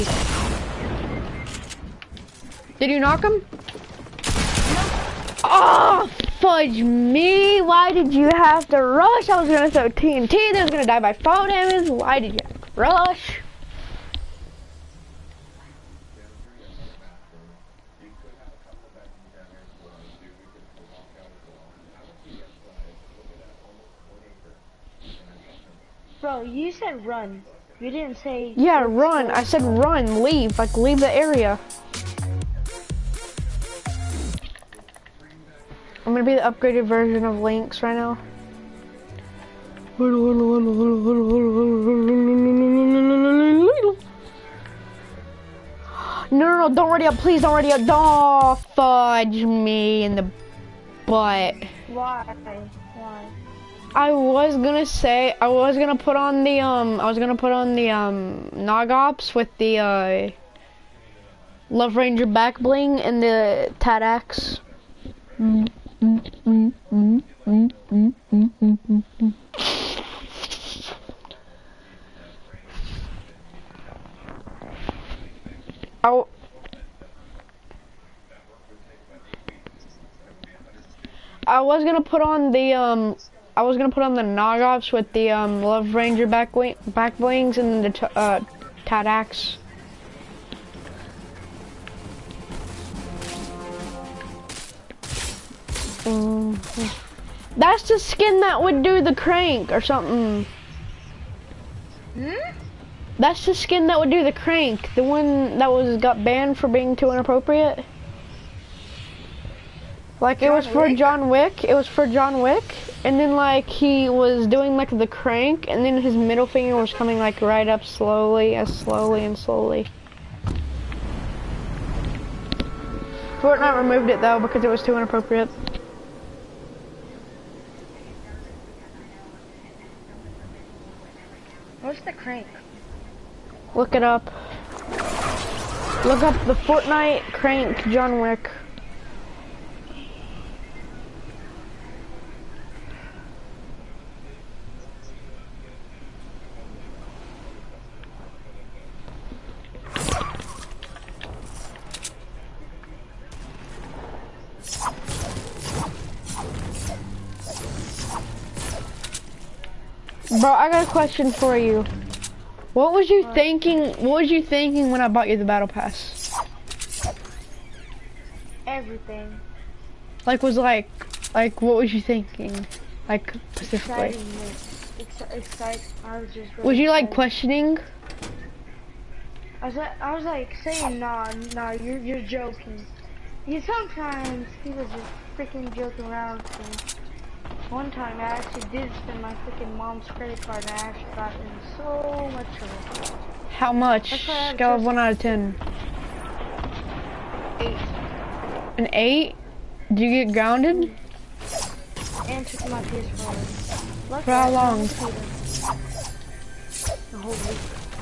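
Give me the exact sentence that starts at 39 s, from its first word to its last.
No, no, no, don't ready up, please don't ready up.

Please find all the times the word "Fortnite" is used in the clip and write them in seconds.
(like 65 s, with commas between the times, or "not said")
123 s, 136 s.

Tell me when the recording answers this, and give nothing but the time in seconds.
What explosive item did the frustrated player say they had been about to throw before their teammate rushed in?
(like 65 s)
9 s.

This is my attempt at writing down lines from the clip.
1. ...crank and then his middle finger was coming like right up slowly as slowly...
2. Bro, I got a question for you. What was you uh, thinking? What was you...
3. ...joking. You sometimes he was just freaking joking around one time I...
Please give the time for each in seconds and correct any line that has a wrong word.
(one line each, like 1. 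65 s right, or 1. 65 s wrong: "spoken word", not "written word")
1. 115 s right
2. 160 s right
3. 182 s right.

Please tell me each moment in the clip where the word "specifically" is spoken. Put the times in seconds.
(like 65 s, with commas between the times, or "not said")
173 s.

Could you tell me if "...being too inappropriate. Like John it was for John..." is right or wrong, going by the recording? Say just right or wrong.
right.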